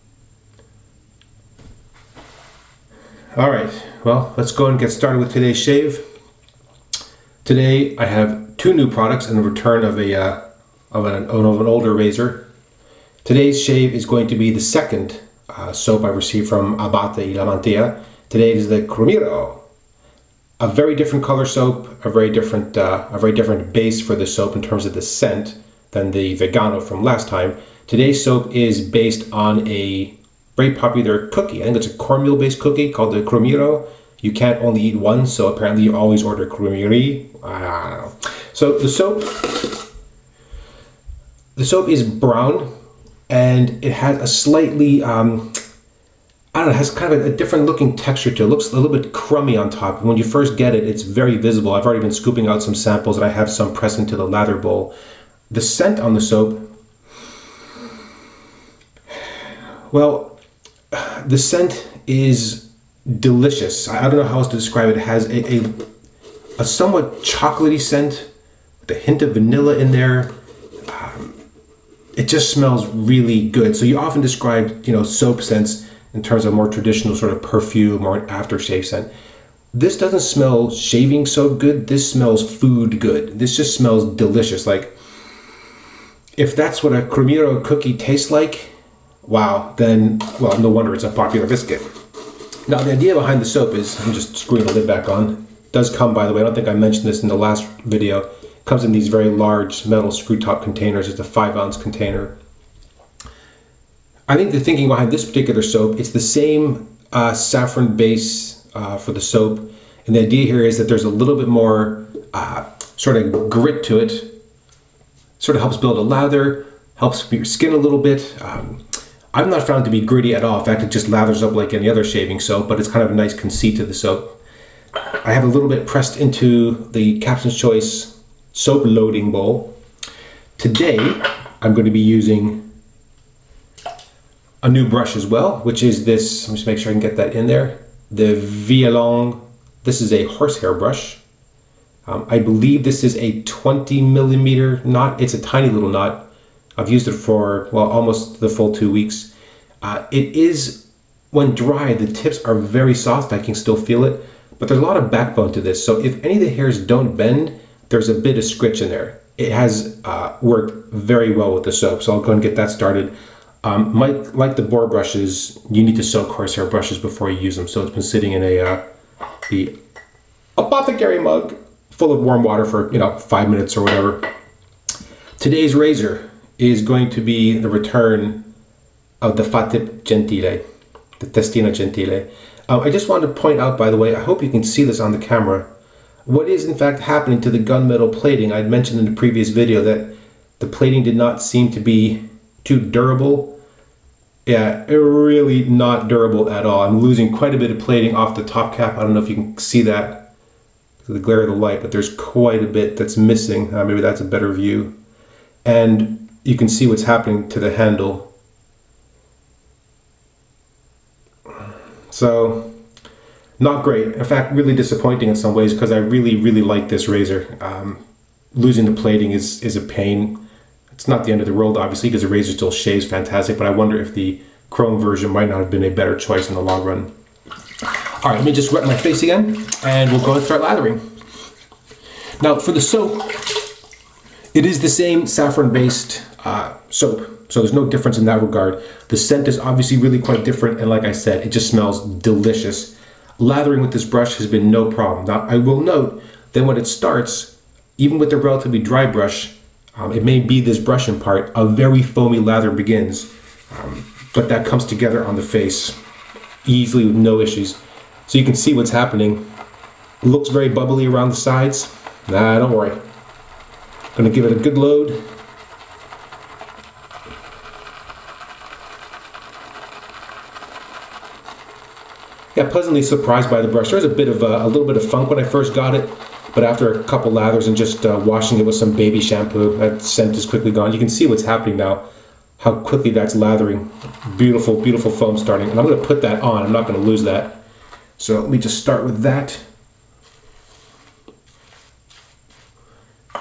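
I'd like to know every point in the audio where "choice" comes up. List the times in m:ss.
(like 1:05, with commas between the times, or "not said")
2:07, 3:46.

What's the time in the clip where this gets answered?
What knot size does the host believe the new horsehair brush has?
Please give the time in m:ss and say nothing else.
2:23.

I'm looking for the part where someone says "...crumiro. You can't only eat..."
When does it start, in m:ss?
0:33.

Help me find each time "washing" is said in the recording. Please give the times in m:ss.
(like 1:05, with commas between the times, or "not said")
4:38.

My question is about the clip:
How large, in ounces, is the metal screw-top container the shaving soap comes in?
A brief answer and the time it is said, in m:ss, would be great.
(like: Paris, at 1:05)
5 ounces, at 1:41.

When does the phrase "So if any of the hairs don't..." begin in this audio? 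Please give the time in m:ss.
2:35.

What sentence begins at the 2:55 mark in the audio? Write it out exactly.
Today's razor is going to be the return of the Fatip Gentile, the Testina Gentile.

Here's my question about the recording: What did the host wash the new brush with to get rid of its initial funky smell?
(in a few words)
Baby shampoo.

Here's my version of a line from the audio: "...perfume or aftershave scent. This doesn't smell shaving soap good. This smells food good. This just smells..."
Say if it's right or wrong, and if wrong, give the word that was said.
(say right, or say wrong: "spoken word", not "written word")
right.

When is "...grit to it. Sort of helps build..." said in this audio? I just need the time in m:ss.
1:53.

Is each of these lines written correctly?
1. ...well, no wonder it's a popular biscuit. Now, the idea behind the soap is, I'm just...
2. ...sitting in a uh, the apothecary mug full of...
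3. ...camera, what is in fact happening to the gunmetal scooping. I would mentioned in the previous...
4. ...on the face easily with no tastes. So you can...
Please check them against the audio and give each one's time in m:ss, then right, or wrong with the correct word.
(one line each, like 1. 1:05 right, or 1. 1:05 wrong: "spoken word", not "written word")
1. 1:30 right
2. 2:48 right
3. 3:05 wrong: "plating", not "scooping"
4. 4:15 wrong: "issues", not "tastes".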